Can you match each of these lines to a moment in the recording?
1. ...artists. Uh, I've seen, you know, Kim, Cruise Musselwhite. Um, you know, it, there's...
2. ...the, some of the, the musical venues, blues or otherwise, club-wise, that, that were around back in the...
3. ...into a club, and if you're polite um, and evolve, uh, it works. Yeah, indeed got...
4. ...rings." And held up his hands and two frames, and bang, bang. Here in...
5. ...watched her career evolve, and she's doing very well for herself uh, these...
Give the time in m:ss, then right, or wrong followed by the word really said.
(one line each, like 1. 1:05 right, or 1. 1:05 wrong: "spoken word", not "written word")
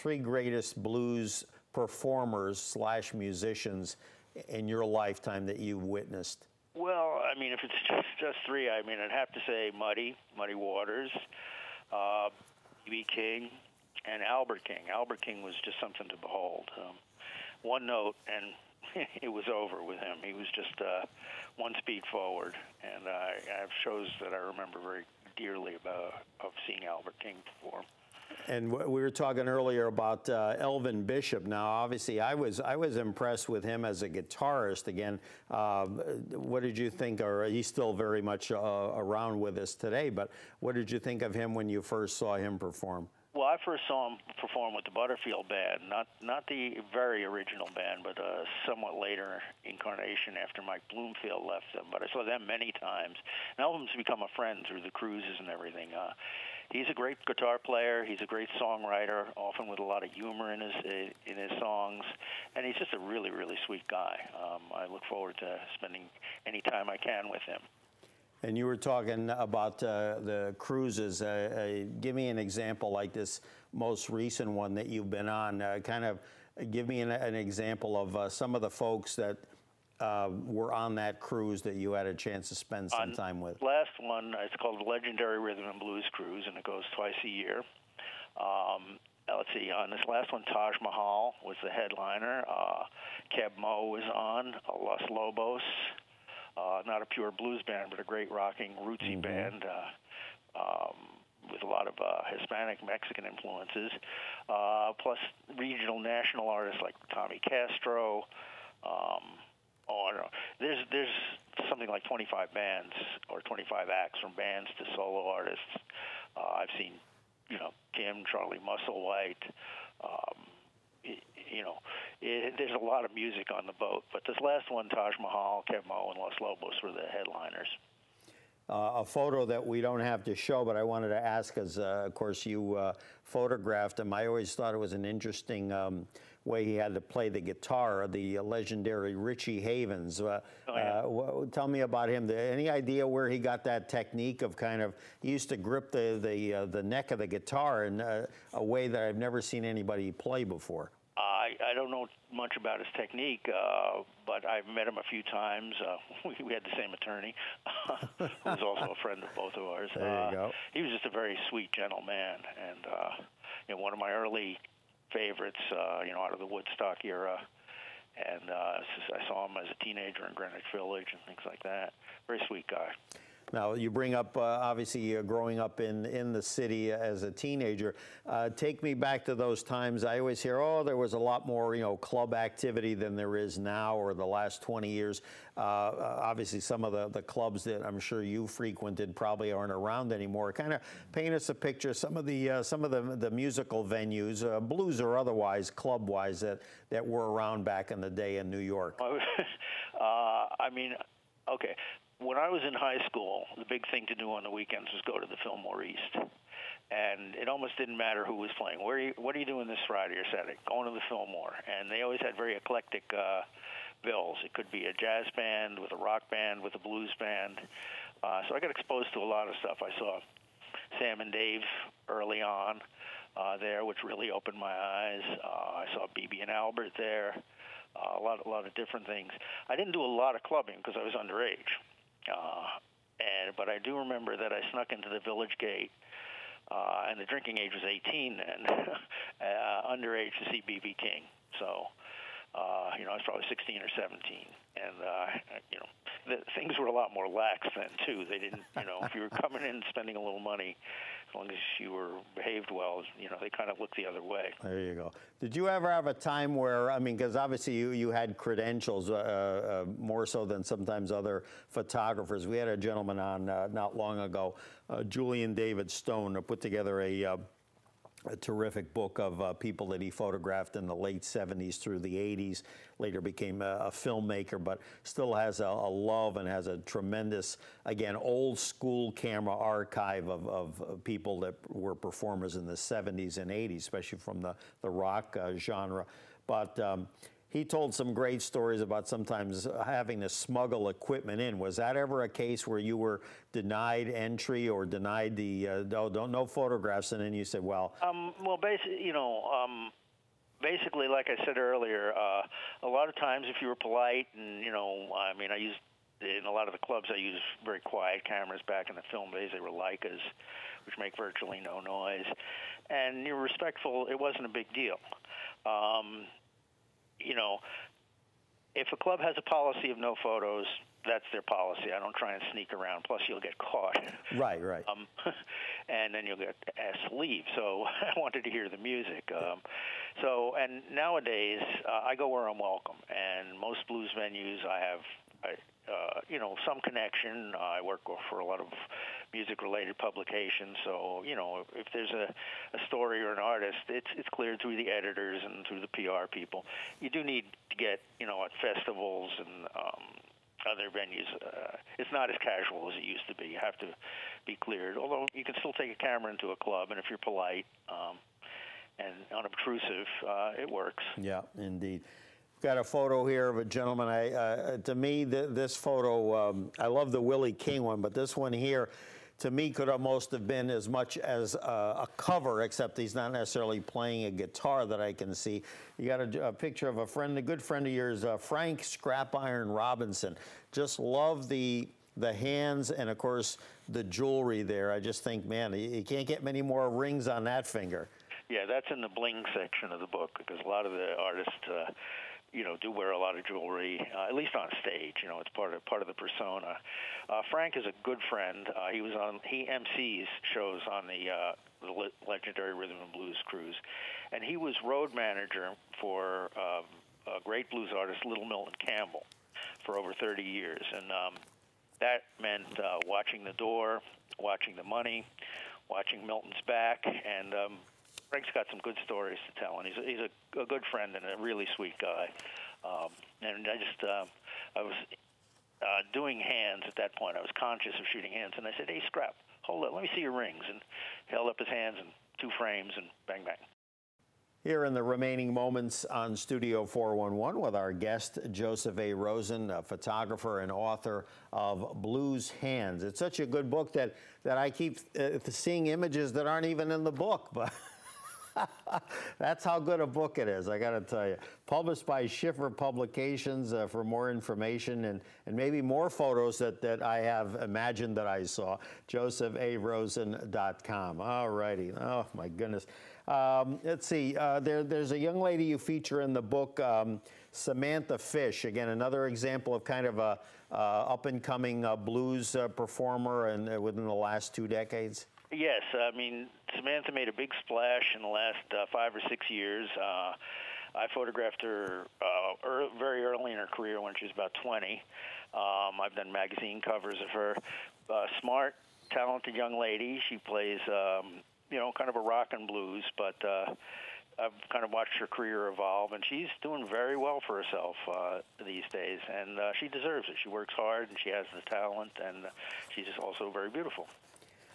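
1. 1:55 wrong: "Charlie", not "Cruise"
2. 3:12 right
3. 5:56 wrong: "unobtrusive", not "evolve"
4. 7:10 right
5. 8:14 right.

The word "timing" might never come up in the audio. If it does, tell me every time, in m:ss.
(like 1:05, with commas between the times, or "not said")
not said.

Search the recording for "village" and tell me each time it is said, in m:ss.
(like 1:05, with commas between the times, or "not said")
2:50, 3:55.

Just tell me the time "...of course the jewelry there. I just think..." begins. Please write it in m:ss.
6:23.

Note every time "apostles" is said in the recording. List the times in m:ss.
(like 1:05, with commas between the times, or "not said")
not said.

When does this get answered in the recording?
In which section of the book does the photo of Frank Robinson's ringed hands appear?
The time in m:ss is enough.
6:29.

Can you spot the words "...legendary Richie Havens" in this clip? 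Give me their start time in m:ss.
2:18.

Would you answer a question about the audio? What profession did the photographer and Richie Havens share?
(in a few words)
Attorney.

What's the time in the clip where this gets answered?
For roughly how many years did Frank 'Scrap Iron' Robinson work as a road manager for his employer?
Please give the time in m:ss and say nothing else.
6:49.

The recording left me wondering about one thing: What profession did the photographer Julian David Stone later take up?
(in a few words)
Filmmaker.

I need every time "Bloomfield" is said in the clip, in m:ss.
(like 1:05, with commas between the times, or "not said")
0:50.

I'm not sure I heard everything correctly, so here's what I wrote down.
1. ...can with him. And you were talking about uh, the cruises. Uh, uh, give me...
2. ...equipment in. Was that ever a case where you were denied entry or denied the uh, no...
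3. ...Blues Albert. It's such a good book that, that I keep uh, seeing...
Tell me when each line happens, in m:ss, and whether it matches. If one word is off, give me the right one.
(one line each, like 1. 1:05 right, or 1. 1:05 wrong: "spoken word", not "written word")
1. 1:06 right
2. 4:50 right
3. 7:22 wrong: "Hands", not "Albert".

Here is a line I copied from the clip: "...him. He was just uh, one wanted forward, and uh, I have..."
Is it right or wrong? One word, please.
wrong.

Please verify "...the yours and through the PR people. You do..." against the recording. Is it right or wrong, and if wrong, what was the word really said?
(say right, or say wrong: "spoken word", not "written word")
wrong: "editors", not "yours".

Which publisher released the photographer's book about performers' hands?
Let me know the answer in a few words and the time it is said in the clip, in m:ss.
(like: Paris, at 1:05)
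Schiffer Publications, at 7:32.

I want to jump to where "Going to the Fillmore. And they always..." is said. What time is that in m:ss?
3:30.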